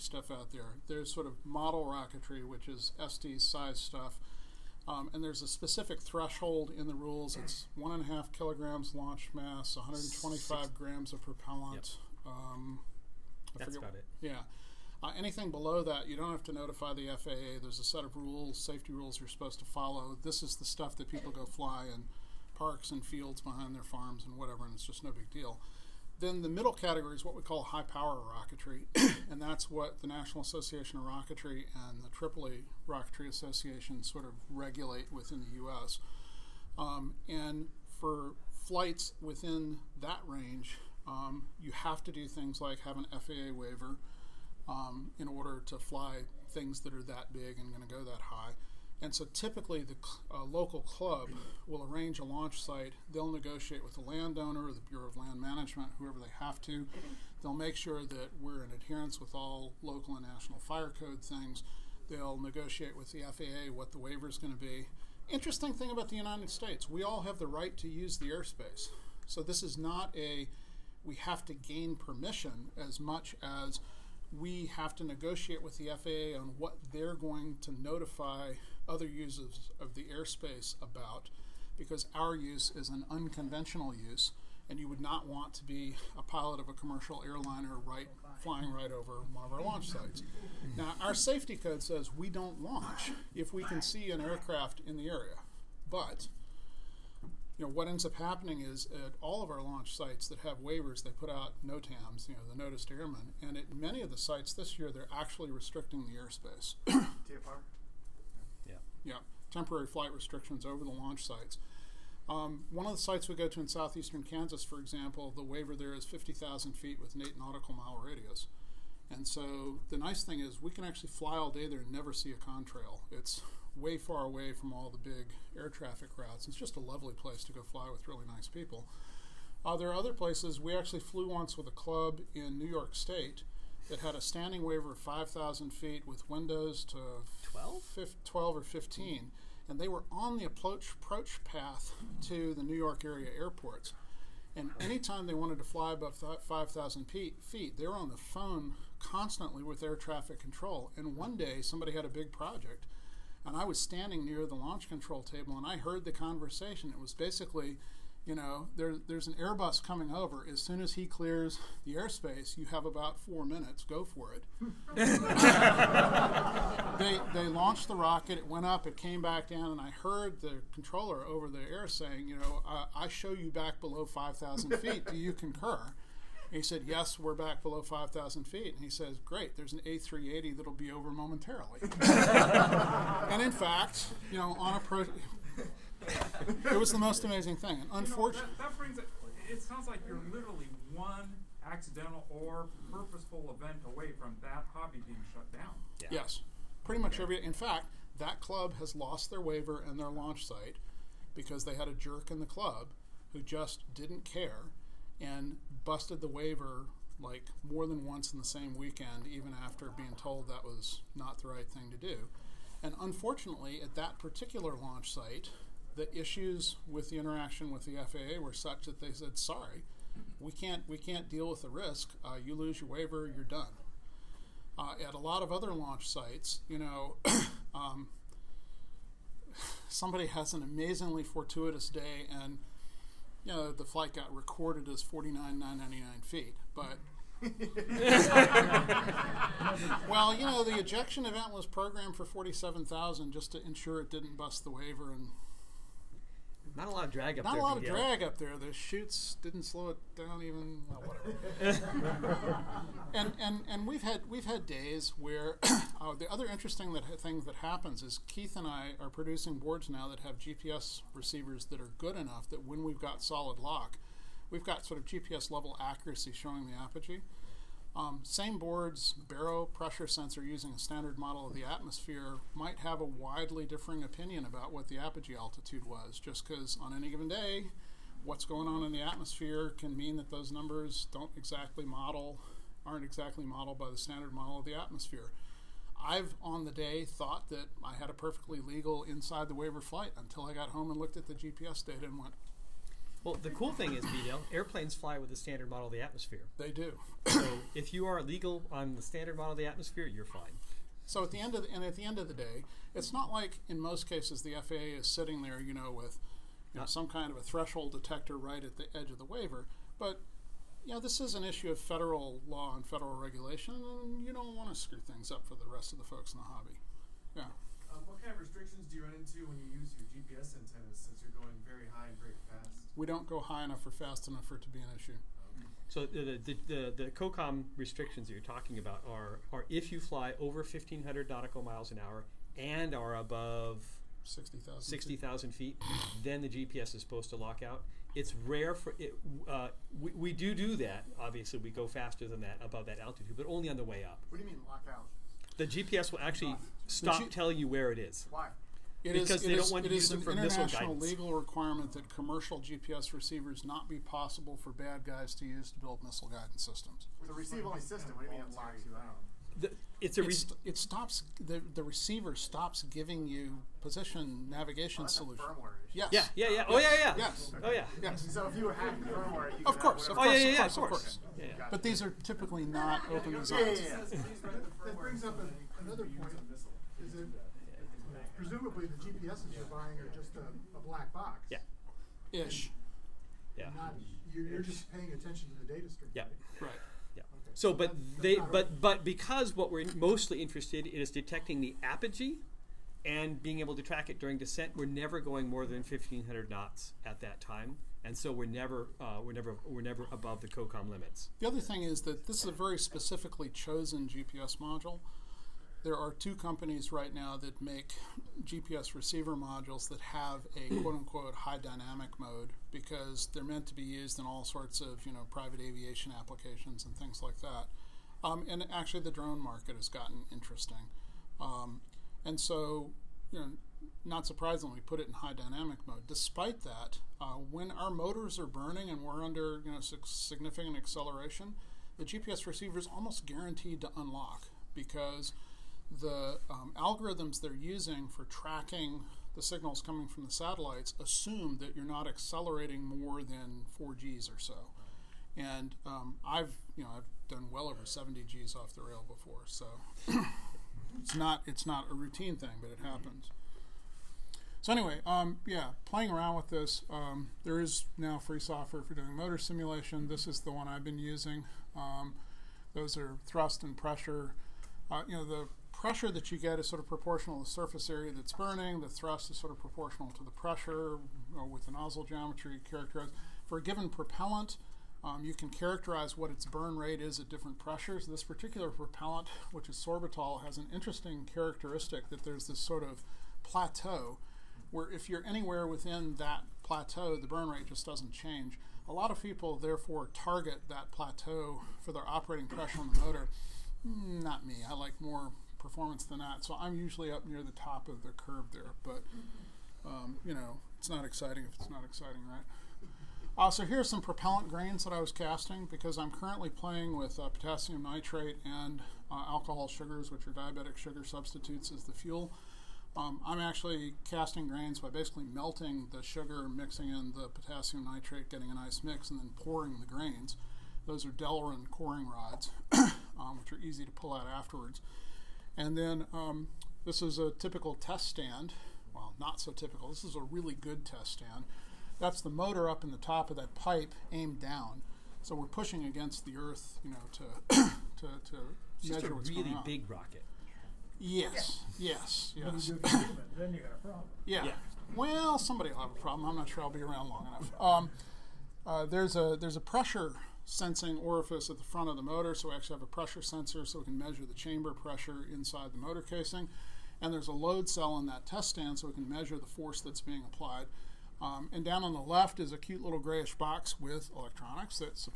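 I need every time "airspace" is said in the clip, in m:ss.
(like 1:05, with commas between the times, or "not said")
1:08, 1:20, 1:46, 2:41.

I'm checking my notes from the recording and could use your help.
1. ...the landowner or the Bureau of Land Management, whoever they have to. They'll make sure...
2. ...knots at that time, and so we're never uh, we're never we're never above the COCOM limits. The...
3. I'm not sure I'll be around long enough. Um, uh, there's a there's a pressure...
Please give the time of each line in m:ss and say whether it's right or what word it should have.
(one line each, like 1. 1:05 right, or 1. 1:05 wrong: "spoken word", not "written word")
1. 0:53 right
2. 6:36 right
3. 9:06 right.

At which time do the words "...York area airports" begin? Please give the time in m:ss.
2:22.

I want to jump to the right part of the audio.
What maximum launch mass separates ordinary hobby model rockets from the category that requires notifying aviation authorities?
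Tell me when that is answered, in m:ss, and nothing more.
0:07.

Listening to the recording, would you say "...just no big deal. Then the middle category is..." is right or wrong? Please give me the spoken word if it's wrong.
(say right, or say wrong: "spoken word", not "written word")
right.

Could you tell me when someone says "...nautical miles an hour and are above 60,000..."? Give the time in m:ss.
5:31.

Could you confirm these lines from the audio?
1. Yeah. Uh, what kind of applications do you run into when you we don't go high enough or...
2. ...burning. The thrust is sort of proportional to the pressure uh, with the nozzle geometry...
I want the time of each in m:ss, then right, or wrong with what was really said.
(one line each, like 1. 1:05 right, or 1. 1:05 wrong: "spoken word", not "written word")
1. 5:17 wrong: "restrictions", not "applications"
2. 7:48 right.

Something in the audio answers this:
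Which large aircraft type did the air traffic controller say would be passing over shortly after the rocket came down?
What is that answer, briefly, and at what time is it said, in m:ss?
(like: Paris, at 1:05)
A380, at 2:59.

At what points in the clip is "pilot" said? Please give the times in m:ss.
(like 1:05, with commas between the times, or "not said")
1:26.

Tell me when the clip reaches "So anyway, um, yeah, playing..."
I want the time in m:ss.
7:34.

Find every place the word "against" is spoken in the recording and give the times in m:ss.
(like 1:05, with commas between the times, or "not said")
8:55.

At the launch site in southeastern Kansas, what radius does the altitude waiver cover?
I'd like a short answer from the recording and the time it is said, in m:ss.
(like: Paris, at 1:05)
8 nautical miles, at 1:57.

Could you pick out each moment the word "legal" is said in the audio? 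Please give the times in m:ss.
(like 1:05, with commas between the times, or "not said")
4:48, 4:58, 5:50.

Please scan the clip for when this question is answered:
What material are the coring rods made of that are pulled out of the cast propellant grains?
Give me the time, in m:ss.
8:41.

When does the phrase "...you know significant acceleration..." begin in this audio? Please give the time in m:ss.
7:09.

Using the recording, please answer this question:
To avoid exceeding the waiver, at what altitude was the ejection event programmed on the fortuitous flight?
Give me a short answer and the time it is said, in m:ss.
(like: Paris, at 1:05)
47,000 feet, at 4:02.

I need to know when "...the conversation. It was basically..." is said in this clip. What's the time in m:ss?
2:36.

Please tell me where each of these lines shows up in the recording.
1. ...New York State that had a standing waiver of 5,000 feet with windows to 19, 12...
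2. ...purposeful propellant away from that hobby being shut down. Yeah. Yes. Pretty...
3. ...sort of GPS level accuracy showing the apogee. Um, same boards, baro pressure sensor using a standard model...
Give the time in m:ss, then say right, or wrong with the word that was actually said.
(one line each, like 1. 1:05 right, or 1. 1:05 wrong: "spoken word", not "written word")
1. 2:12 wrong: "12", not "19"
2. 3:12 wrong: "event", not "propellant"
3. 4:24 right.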